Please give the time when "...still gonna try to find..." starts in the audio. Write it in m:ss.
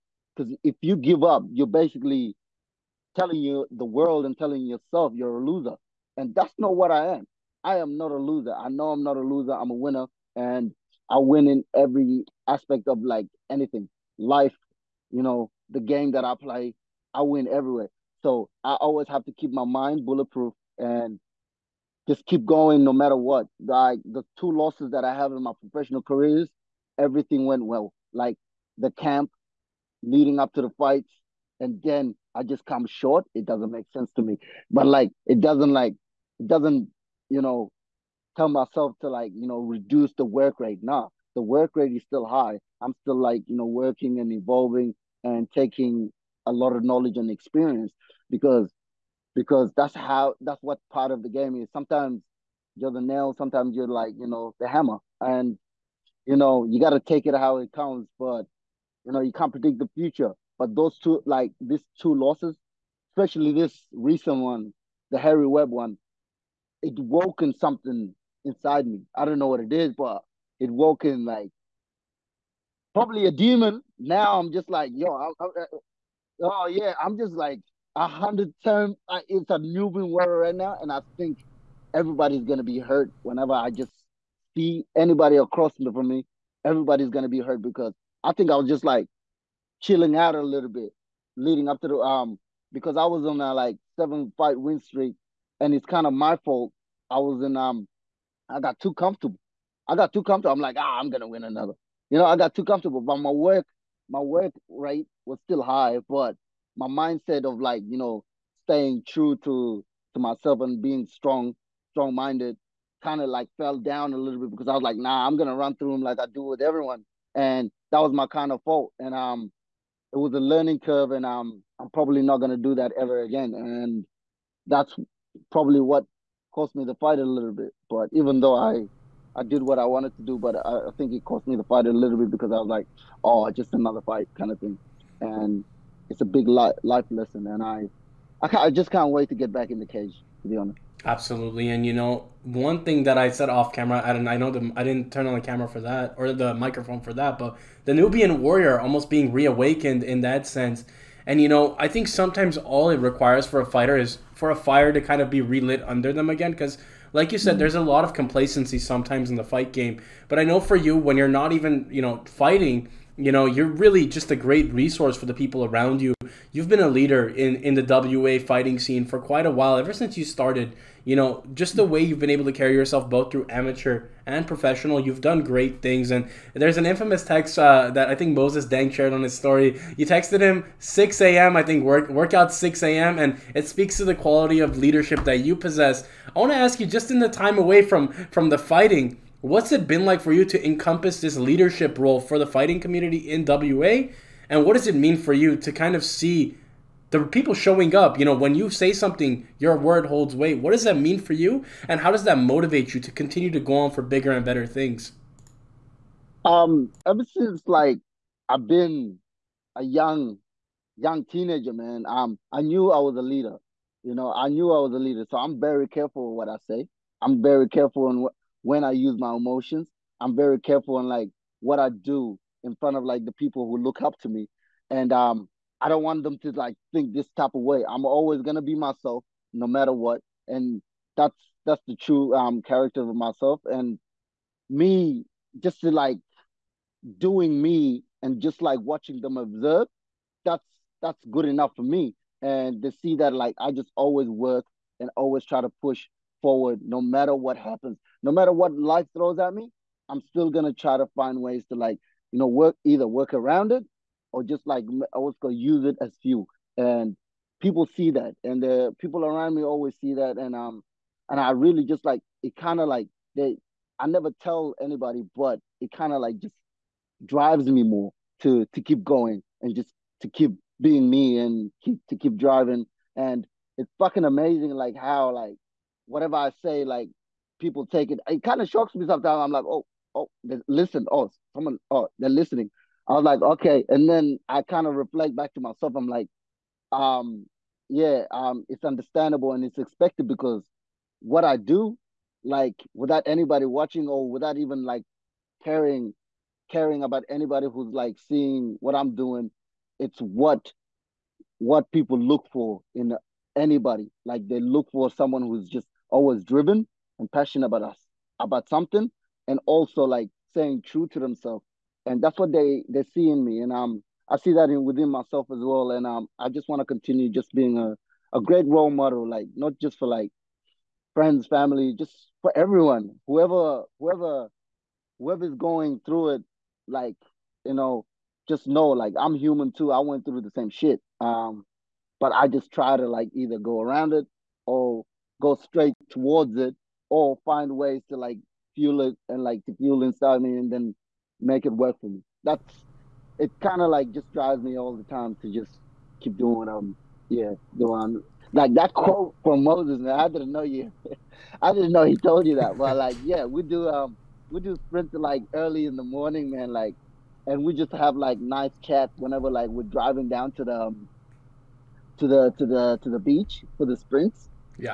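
4:10.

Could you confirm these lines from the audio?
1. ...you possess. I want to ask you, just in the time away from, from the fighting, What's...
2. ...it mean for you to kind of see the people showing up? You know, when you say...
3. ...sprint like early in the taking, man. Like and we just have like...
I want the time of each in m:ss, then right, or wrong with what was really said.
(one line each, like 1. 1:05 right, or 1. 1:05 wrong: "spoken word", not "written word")
1. 3:05 right
2. 3:14 right
3. 5:54 wrong: "morning", not "taking".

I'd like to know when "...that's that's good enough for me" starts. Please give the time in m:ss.
4:00.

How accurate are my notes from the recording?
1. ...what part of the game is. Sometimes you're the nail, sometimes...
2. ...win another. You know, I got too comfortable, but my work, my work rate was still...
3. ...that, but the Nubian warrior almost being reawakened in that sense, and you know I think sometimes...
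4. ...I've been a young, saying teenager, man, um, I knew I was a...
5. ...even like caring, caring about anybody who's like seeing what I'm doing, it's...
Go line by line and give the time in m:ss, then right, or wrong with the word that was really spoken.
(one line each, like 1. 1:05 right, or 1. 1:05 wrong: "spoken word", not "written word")
1. 0:50 right
2. 1:41 right
3. 2:27 right
4. 3:28 wrong: "young", not "saying"
5. 4:54 right.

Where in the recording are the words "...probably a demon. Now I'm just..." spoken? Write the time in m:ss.
1:12.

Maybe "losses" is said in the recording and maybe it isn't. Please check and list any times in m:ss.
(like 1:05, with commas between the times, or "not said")
0:24, 1:02.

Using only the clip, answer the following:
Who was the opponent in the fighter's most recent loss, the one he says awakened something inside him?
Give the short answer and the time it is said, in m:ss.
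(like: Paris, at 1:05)
Harry Webb, at 1:05.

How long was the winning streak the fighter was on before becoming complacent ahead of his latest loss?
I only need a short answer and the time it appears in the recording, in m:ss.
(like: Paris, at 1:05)
7 fights, at 1:33.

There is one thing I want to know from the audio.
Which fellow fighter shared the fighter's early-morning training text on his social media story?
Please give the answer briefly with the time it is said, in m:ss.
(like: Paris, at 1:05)
Moses Deng, at 2:58.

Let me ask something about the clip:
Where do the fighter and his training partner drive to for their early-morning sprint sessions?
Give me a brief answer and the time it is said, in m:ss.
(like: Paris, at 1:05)
The beach, at 6:03.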